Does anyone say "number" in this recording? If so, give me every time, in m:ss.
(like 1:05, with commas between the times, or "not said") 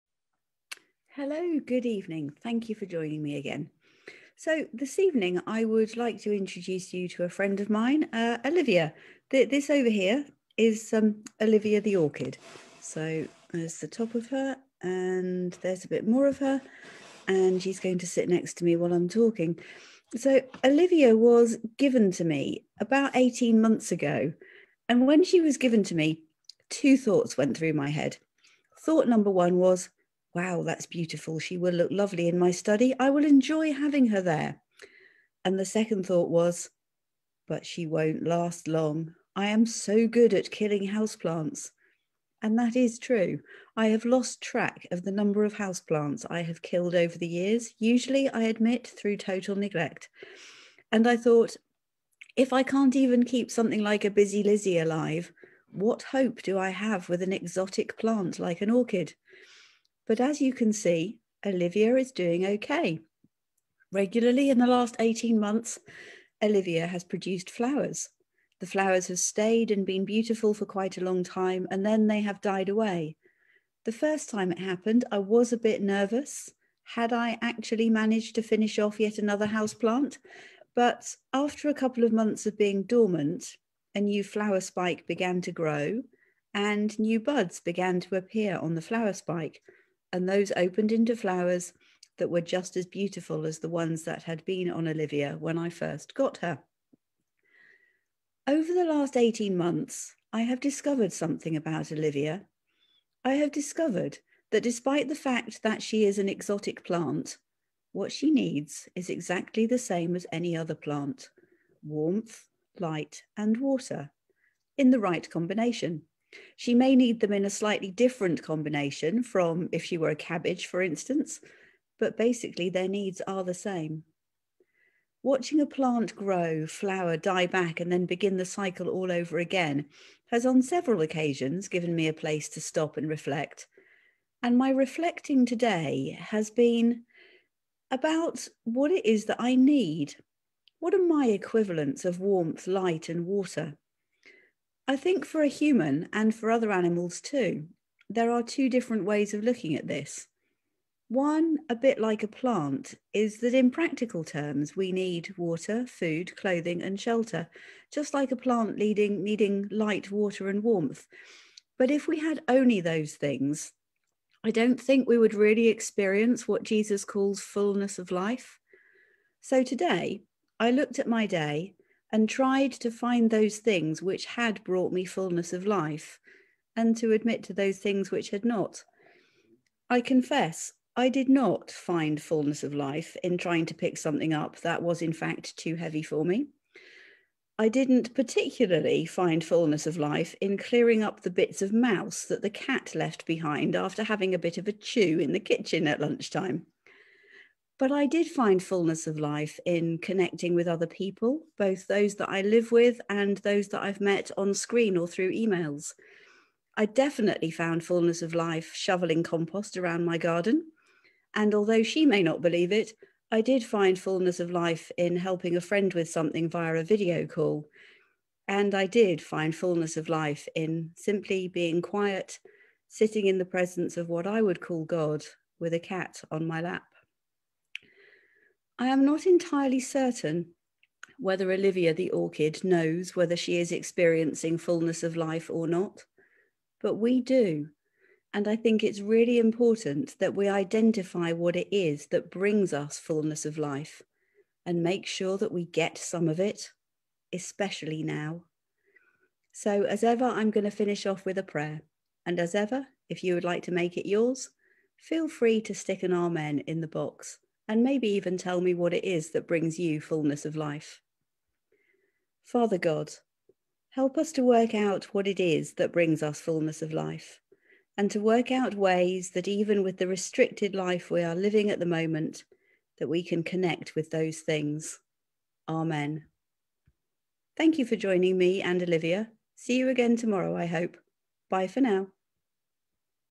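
0:29, 0:45.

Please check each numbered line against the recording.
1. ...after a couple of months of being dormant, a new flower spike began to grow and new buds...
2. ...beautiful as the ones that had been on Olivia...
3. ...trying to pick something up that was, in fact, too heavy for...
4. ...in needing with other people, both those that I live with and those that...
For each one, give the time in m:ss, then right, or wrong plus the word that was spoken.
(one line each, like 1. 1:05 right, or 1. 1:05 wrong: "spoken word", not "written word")
1. 1:21 right
2. 1:32 right
3. 3:03 right
4. 3:19 wrong: "connecting", not "needing".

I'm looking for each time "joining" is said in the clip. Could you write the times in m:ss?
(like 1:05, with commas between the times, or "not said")
0:02, 4:37.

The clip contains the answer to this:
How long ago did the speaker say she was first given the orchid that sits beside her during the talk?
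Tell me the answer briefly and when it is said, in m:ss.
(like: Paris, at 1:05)
18 months, at 0:23.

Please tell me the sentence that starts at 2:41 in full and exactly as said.
But if we had only those things, I don't think we would really experience what Jesus calls fullness of life.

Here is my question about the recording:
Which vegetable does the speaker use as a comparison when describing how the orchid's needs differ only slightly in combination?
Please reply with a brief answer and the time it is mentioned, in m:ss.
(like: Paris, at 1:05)
Cabbage, at 2:00.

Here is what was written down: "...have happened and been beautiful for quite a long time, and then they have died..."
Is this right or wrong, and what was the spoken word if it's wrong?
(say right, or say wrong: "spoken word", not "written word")
wrong: "stayed", not "happened".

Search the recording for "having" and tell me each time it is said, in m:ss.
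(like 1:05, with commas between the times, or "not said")
0:33, 3:14.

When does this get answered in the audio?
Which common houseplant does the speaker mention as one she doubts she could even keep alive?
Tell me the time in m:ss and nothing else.
0:54.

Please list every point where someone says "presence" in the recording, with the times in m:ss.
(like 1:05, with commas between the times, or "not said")
3:43.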